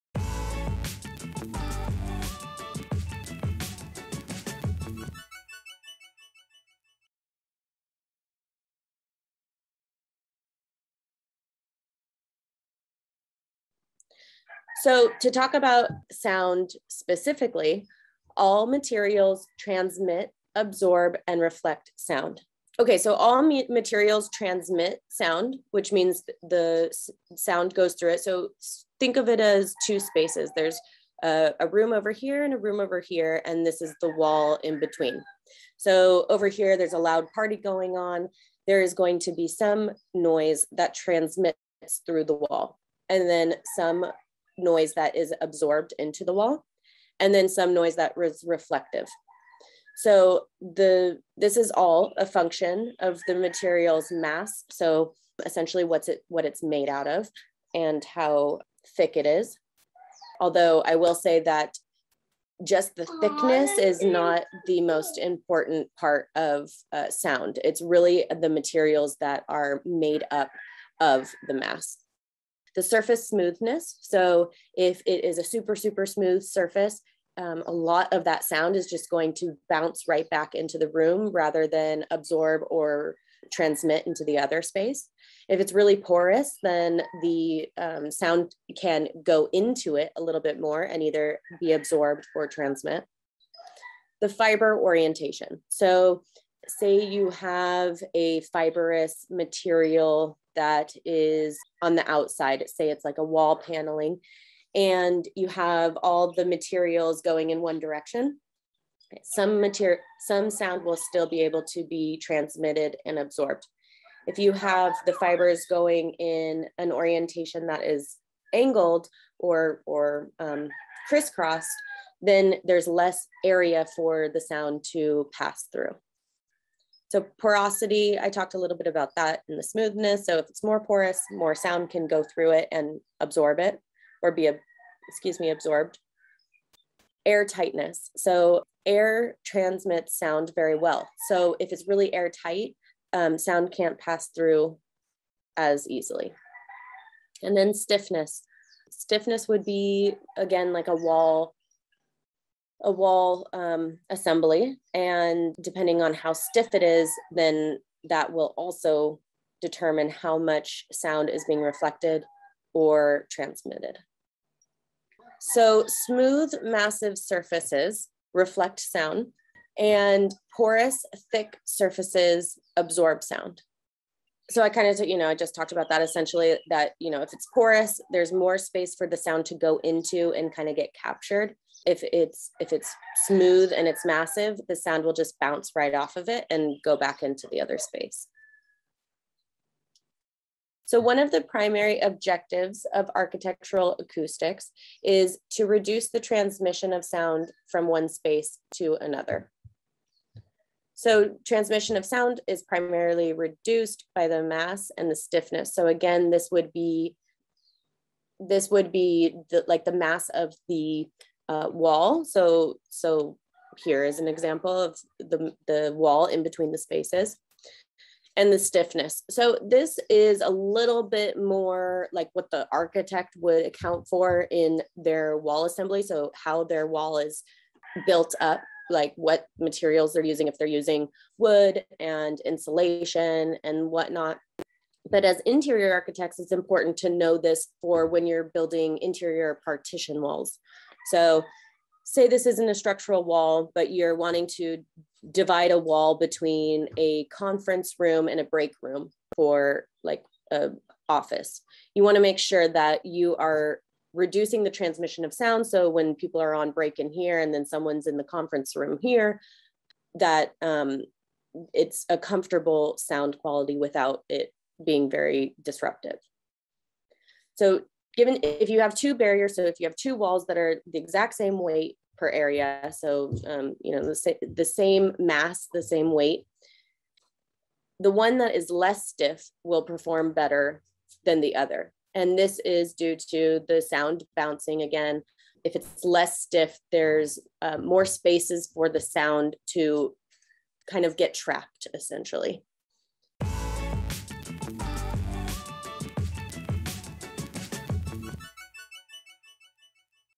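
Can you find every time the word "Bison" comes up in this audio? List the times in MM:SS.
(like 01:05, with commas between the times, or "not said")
not said.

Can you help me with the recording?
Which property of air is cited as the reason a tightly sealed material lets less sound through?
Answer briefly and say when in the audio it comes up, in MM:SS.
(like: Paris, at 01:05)
air transmits sound very well, at 02:18.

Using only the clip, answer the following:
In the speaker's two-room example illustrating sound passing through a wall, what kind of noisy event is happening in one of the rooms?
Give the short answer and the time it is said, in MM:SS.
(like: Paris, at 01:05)
a loud party, at 00:36.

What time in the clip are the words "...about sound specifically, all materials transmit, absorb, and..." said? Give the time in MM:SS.
00:15.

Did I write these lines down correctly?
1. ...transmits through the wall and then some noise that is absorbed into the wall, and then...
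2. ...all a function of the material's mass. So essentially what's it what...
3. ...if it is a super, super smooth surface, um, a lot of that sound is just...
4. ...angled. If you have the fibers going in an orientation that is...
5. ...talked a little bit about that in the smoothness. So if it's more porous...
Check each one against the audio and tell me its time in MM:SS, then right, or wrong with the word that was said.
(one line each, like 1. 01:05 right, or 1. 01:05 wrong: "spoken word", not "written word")
1. 00:40 right
2. 00:51 right
3. 01:14 right
4. 01:53 wrong: "absorbed", not "angled"
5. 02:08 right.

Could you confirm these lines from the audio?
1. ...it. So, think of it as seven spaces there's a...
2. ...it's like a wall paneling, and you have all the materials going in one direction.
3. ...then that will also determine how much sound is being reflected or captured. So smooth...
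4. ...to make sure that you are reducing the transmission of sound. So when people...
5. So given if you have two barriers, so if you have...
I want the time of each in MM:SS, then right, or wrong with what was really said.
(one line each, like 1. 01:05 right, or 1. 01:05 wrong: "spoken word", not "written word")
1. 00:28 wrong: "two", not "seven"
2. 01:42 right
3. 02:37 wrong: "transmitted", not "captured"
4. 04:12 right
5. 04:27 right.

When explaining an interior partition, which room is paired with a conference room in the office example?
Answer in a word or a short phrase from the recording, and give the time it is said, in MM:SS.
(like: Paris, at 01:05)
break room, at 04:08.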